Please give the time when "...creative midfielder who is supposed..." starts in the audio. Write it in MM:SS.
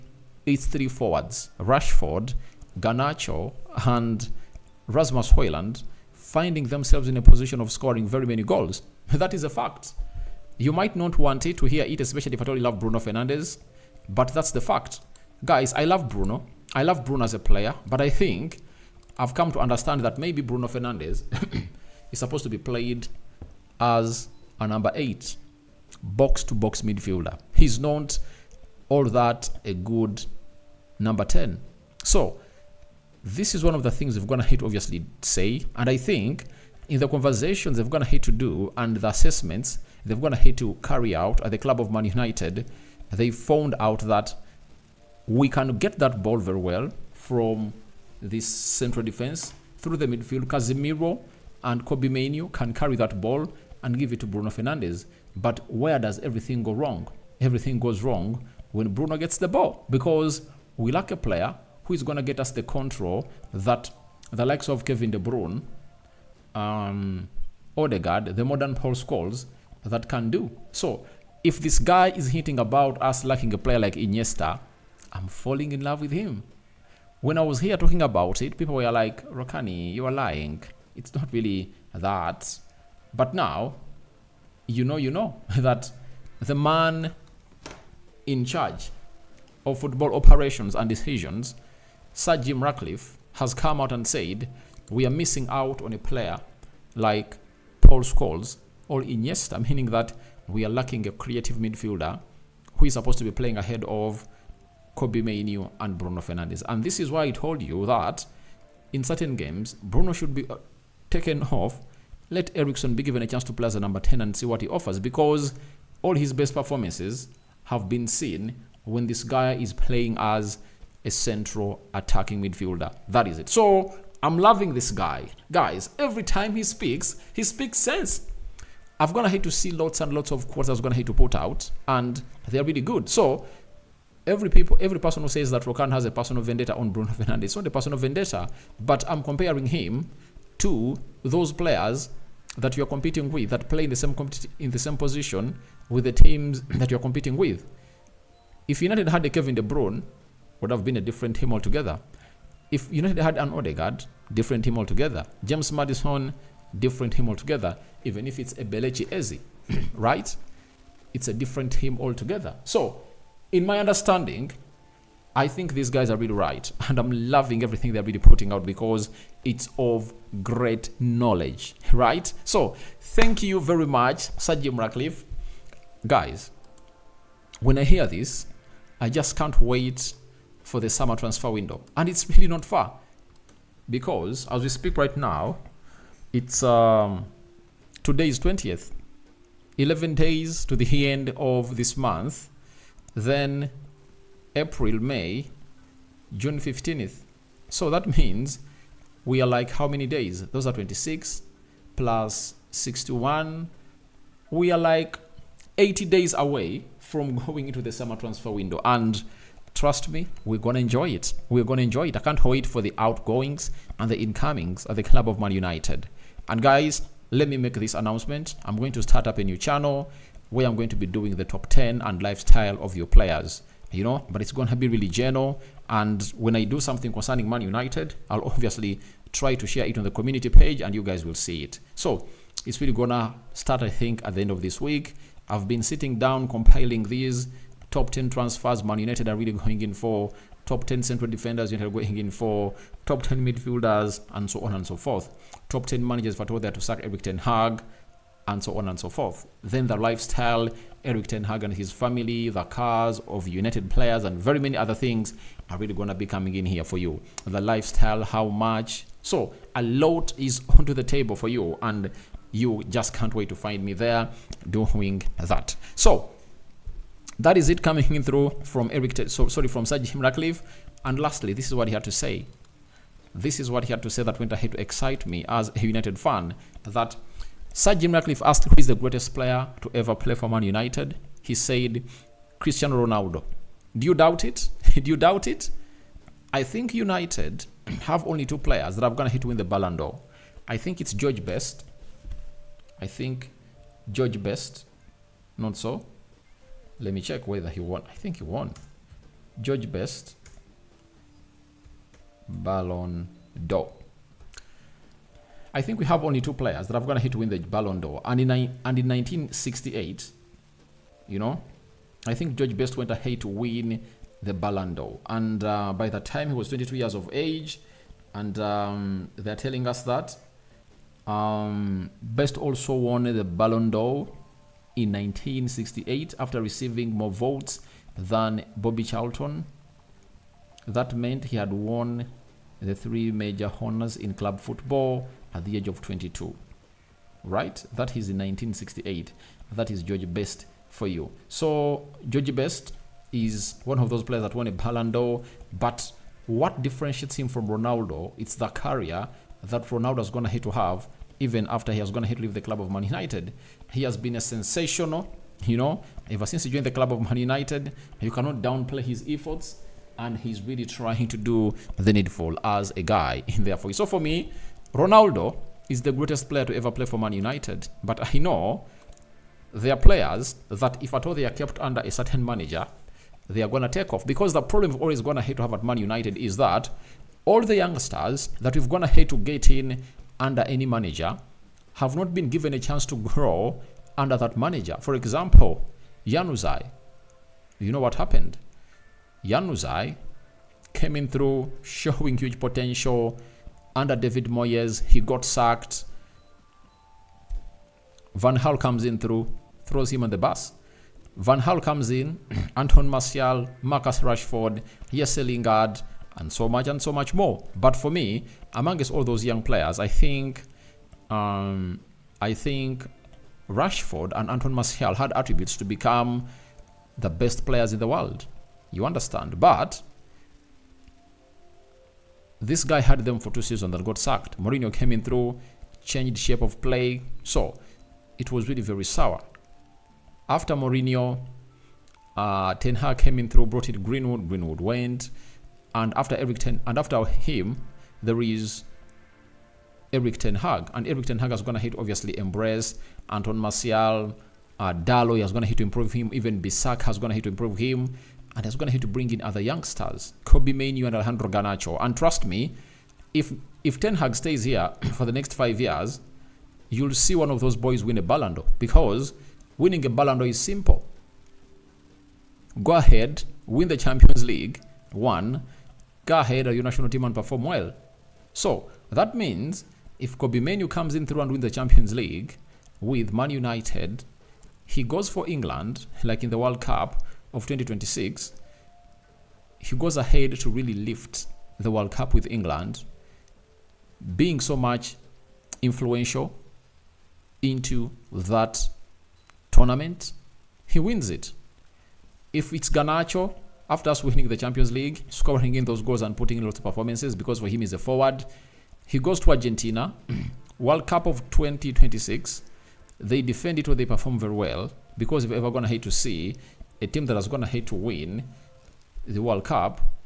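01:41.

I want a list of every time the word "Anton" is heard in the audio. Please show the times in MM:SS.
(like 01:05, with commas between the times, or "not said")
06:42, 06:54, 07:23.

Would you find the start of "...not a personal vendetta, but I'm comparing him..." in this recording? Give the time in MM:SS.
02:17.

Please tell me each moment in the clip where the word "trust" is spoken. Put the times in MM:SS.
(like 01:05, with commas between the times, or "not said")
03:29, 07:32.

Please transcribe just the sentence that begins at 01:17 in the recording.
When I was here talking about it, people were like, Rokani, you are lying.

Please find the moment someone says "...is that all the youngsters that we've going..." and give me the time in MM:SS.
06:16.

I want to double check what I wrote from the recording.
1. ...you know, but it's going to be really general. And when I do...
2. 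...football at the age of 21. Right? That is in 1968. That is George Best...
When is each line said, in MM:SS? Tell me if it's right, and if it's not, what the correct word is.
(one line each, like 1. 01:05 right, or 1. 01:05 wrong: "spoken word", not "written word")
1. 03:43 right
2. 05:34 wrong: "22", not "21".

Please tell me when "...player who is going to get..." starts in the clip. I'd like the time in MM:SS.
01:01.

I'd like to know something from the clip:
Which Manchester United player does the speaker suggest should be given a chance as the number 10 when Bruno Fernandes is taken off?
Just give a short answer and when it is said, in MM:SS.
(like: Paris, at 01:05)
Eriksen, at 01:52.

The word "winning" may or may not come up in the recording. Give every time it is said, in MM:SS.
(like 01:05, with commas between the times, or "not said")
07:39, 08:14.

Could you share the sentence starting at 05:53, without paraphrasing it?
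He has been a sensational, you know, ever since he joined the club of Man United.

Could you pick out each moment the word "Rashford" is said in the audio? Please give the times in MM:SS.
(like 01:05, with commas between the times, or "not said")
00:01, 06:44, 06:53.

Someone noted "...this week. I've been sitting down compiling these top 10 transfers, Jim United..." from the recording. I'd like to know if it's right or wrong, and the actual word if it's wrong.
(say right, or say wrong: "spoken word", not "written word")
wrong: "Man", not "Jim".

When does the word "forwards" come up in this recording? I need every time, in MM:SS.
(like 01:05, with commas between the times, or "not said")
00:00, 08:17.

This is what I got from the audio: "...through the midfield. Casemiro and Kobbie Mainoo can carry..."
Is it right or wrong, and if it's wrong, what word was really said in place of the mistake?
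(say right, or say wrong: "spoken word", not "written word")
right.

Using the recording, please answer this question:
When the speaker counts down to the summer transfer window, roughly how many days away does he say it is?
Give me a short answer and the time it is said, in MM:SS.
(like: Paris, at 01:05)
80, at 03:25.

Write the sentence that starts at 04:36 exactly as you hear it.
That Sir Jim Ratcliffe asked who is the greatest player to ever play for Man United.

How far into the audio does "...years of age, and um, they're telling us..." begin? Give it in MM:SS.
05:16.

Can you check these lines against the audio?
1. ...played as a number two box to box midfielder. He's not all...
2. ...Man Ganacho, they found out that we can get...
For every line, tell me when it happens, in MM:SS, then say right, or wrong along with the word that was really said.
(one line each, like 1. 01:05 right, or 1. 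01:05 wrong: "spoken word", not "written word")
1. 00:22 wrong: "eight", not "two"
2. 00:41 wrong: "United", not "Ganacho".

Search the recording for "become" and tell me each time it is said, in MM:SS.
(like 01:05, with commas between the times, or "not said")
06:55.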